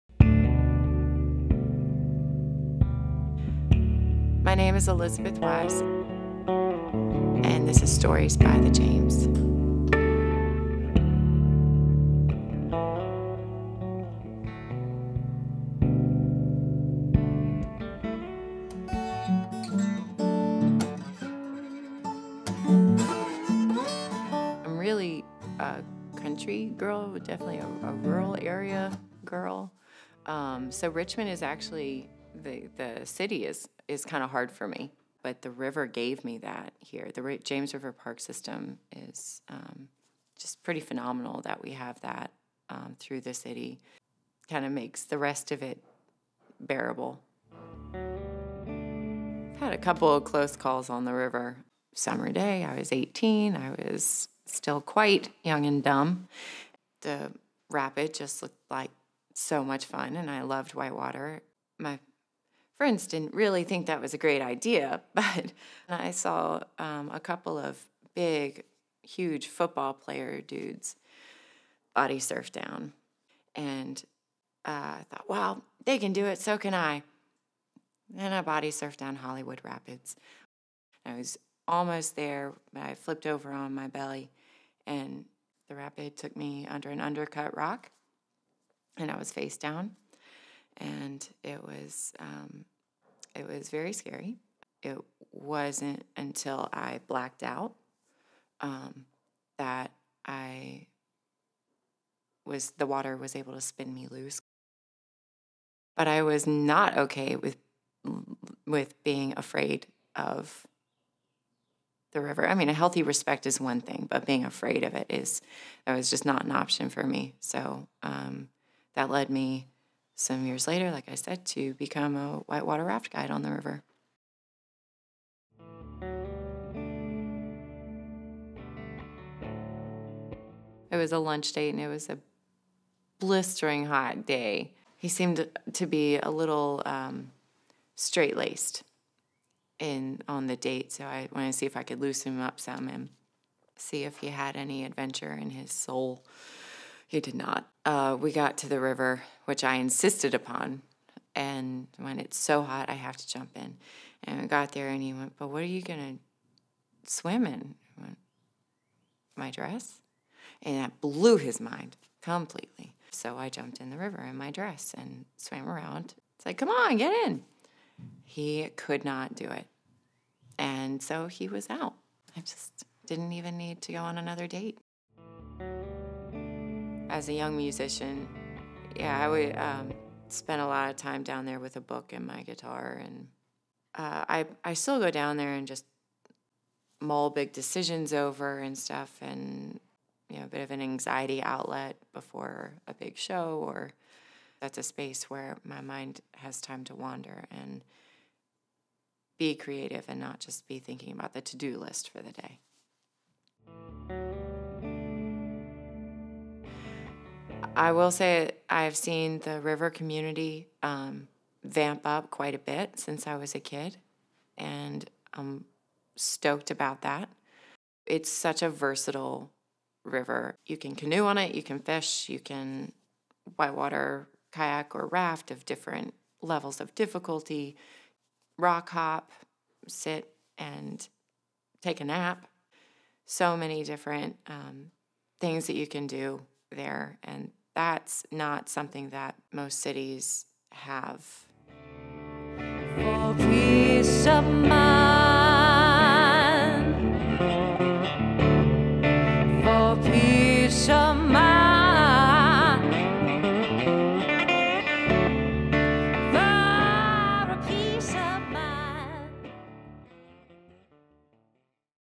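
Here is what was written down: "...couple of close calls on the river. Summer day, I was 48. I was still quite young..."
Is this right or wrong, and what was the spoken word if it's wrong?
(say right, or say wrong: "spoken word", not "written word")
wrong: "18", not "48".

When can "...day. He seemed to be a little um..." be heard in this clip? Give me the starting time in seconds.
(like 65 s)
134 s.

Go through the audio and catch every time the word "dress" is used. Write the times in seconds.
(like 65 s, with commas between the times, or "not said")
159 s, 164 s.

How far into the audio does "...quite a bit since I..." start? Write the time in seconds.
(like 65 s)
212 s.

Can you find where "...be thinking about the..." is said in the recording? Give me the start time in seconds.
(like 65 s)
200 s.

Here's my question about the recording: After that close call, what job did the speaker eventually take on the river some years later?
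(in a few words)
Whitewater raft guide.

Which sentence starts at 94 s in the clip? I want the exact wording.
It wasn't until I blacked out um, that I was the water was able to spin me loose.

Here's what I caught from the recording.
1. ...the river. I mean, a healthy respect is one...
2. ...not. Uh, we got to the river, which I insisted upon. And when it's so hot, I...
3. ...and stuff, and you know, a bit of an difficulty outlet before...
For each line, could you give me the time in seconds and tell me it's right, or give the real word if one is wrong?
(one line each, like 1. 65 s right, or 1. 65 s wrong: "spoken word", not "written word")
1. 112 s right
2. 147 s right
3. 188 s wrong: "anxiety", not "difficulty".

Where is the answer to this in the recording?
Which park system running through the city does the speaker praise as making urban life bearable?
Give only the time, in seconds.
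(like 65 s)
37 s.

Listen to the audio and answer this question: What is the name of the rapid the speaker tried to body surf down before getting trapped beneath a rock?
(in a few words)
Hollywood Rapids.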